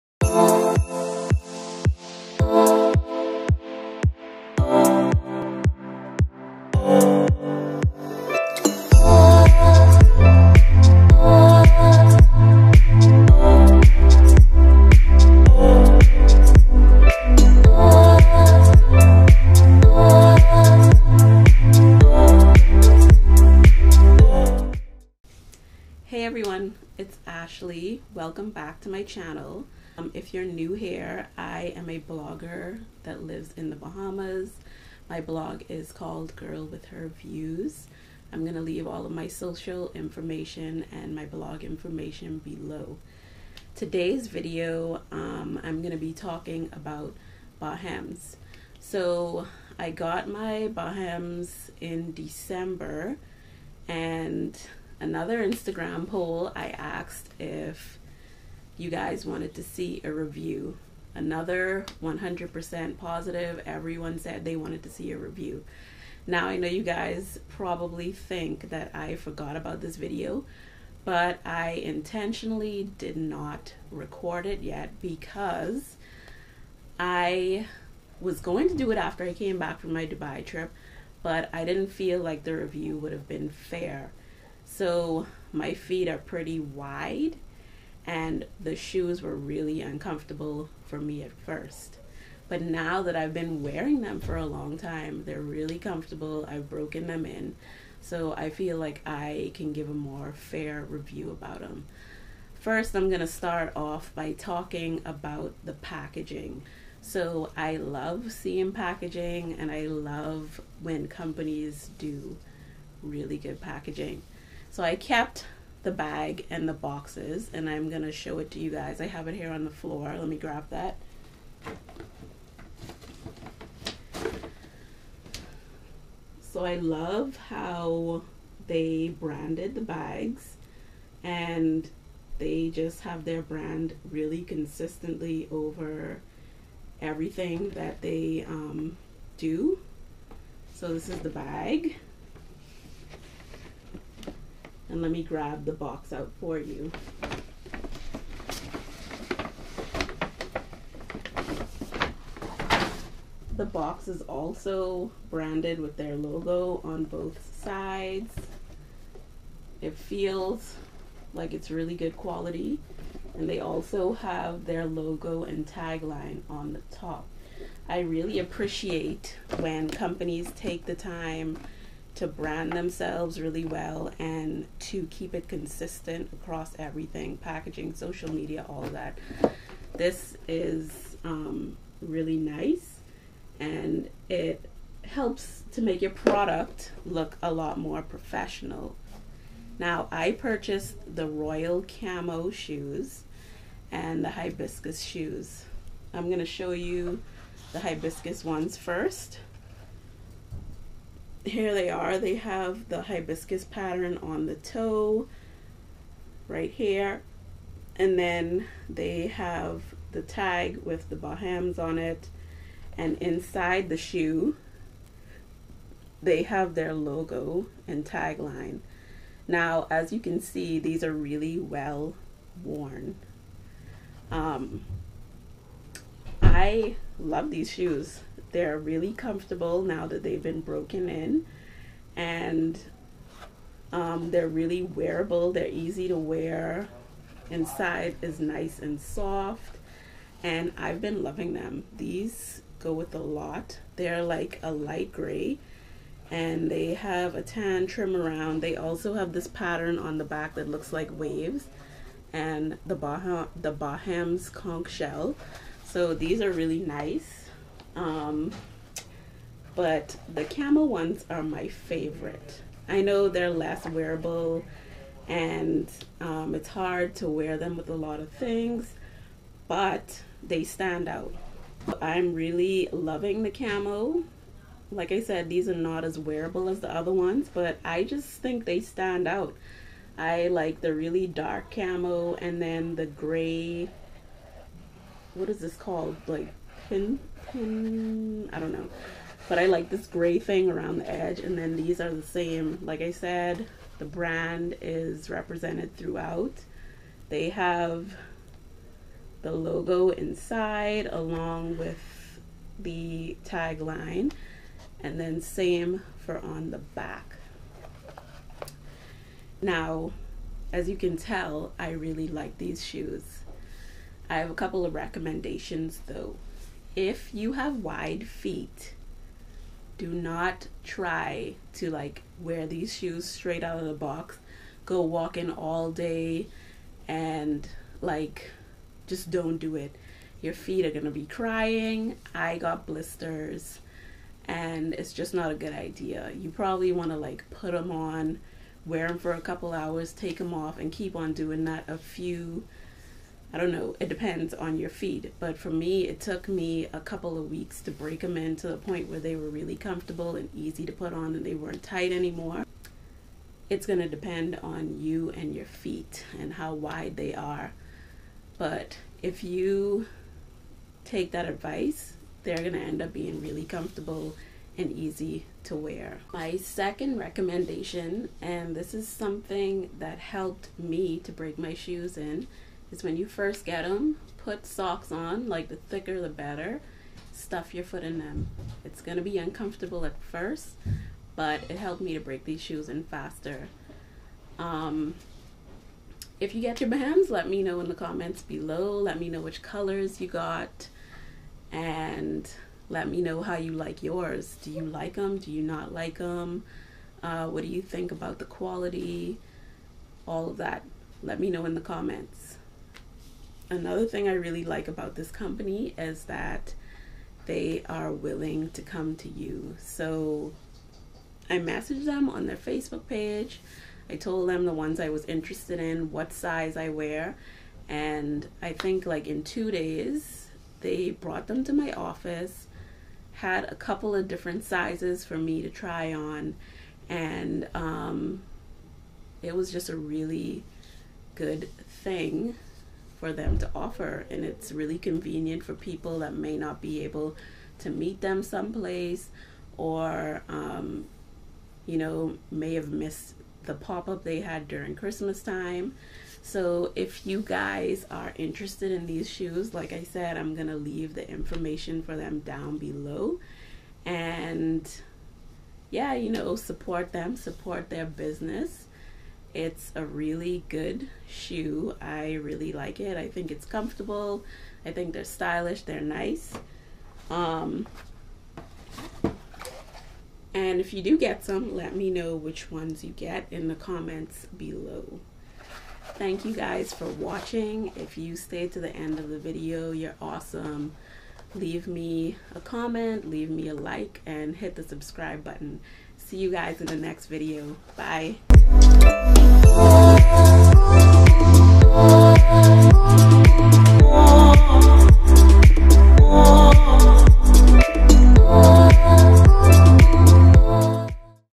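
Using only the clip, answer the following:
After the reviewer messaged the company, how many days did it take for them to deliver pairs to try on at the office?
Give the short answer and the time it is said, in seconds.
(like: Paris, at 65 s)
2, at 419 s.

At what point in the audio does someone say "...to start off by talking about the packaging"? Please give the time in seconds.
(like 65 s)
103 s.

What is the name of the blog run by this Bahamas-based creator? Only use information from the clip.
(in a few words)
Girl With Her Views.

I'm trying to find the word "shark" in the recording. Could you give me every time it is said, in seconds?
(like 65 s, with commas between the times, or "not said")
not said.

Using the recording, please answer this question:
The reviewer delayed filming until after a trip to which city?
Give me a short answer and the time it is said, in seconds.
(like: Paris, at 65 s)
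Dubai, at 80 s.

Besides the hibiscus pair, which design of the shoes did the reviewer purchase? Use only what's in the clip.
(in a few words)
royal camo.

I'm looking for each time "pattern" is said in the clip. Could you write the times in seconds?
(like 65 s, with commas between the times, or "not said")
203 s, 249 s.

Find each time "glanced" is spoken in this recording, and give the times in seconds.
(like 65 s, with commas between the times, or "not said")
not said.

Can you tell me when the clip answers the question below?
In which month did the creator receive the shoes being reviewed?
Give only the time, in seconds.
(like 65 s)
52 s.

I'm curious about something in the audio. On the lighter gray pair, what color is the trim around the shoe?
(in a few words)
tan.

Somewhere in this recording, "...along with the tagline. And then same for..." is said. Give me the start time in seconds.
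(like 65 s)
301 s.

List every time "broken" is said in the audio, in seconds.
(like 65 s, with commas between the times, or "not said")
96 s, 230 s.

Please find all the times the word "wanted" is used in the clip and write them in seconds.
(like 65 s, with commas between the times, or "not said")
59 s, 64 s.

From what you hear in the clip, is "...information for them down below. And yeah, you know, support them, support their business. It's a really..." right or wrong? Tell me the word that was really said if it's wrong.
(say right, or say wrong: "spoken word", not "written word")
right.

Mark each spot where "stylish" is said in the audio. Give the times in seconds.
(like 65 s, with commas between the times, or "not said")
465 s.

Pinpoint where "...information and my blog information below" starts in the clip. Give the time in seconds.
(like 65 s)
39 s.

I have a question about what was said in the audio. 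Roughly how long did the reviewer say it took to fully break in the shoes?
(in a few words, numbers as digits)
a couple of weeks.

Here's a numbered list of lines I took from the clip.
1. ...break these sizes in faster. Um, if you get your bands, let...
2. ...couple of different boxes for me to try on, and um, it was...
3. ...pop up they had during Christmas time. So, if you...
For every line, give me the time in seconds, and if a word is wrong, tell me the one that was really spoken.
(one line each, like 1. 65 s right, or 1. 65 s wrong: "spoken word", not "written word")
1. 382 s wrong: "shoes", not "sizes"
2. 423 s wrong: "sizes", not "boxes"
3. 443 s right.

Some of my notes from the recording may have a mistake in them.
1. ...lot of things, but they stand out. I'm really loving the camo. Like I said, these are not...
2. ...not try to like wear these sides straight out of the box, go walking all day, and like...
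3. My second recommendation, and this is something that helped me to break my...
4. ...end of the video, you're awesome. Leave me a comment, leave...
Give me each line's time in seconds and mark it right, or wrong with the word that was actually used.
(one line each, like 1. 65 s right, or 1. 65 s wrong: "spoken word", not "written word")
1. 267 s right
2. 320 s wrong: "shoes", not "sides"
3. 366 s right
4. 478 s right.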